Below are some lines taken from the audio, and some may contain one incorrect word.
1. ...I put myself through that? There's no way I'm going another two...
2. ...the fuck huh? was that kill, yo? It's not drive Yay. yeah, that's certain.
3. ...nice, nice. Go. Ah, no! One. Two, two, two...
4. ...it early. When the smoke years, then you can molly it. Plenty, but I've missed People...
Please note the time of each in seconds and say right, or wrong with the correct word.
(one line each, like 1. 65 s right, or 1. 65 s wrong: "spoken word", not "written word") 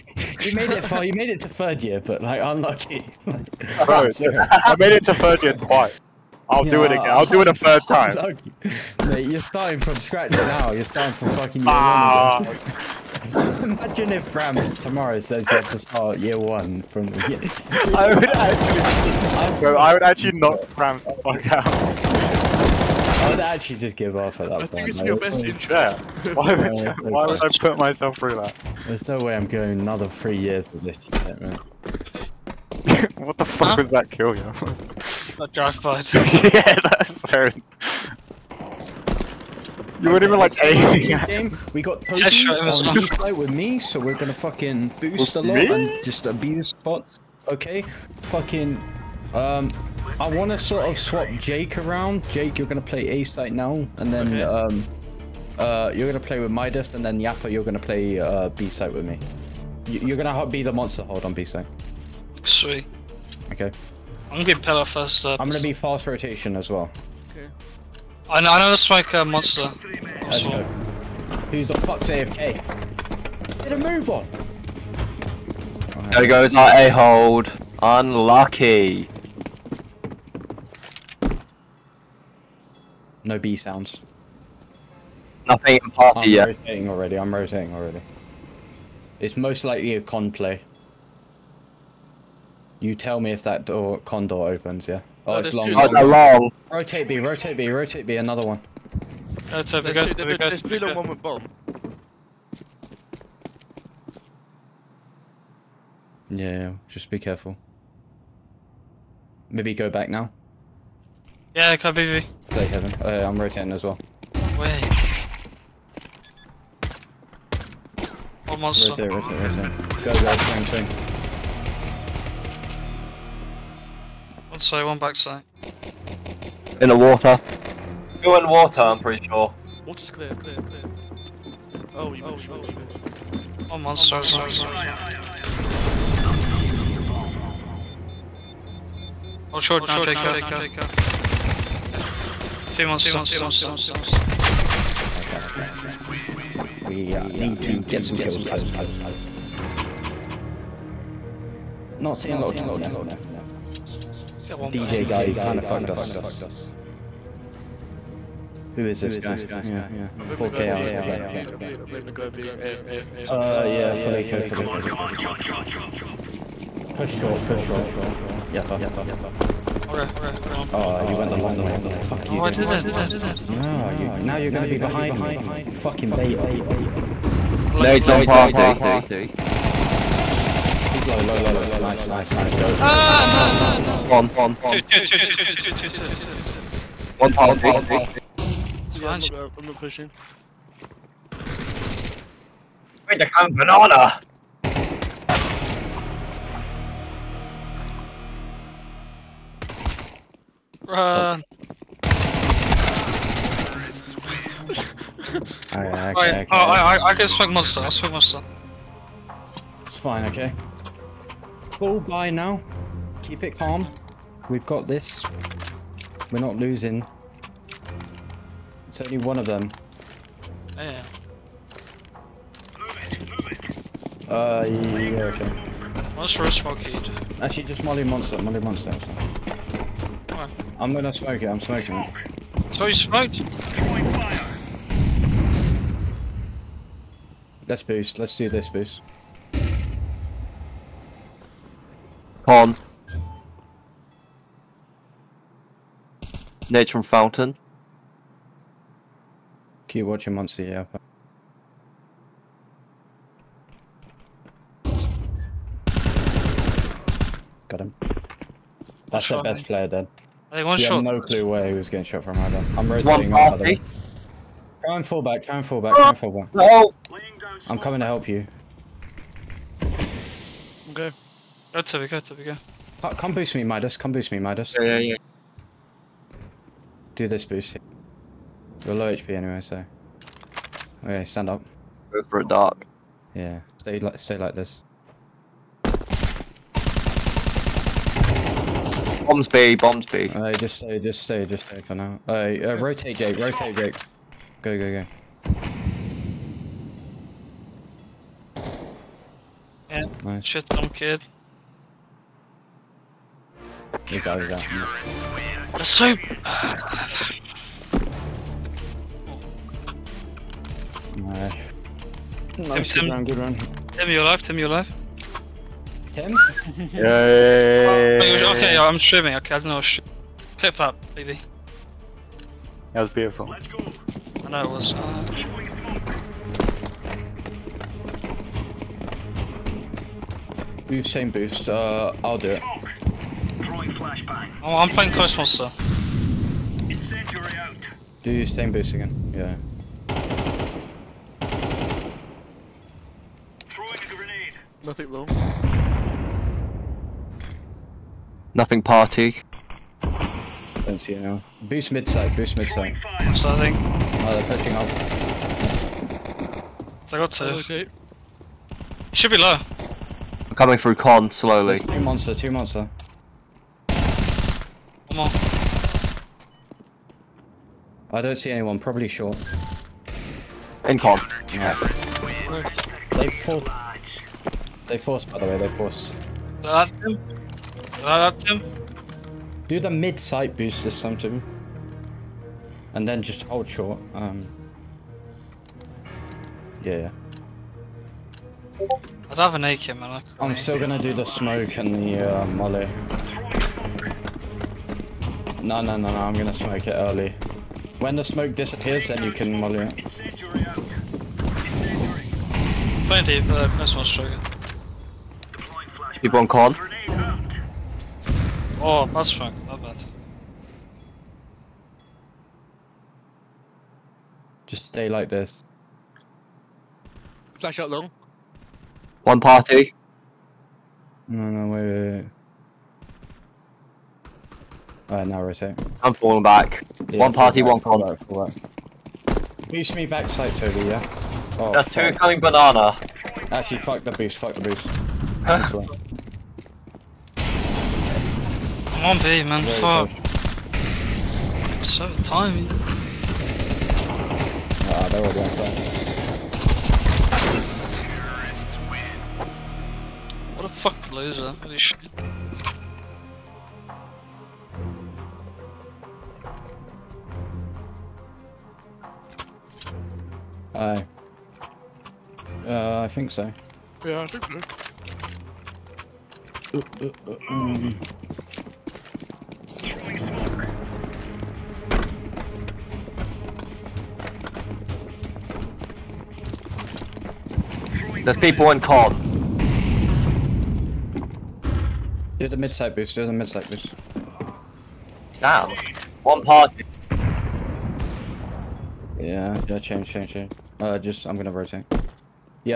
1. 27 s wrong: "three", not "two"
2. 33 s wrong: "Bud", not "Yay"
3. 182 s right
4. 396 s wrong: "disappears", not "years".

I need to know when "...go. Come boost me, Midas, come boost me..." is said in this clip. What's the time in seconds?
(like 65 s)
272 s.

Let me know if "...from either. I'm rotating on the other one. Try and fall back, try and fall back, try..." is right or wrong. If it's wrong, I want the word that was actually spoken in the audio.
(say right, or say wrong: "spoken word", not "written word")
right.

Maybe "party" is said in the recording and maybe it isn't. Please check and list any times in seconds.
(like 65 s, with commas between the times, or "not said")
85 s, 178 s, 187 s, 348 s, 419 s, 427 s, 486 s.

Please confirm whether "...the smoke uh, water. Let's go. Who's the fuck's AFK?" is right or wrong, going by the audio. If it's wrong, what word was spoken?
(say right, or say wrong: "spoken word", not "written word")
wrong: "monster", not "water".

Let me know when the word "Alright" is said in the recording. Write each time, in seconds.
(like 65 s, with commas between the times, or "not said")
169 s, 205 s, 425 s.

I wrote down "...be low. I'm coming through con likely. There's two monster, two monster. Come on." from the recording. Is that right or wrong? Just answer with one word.
wrong.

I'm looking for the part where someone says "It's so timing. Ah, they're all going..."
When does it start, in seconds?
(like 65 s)
441 s.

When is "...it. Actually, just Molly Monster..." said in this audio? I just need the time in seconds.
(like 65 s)
226 s.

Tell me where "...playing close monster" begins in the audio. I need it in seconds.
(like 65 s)
334 s.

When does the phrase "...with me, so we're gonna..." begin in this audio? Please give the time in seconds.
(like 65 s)
43 s.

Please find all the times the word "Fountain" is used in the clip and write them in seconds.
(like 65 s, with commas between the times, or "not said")
247 s.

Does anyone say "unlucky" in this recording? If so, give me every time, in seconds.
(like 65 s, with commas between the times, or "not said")
2 s, 77 s.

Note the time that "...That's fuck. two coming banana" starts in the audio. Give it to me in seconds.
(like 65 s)
431 s.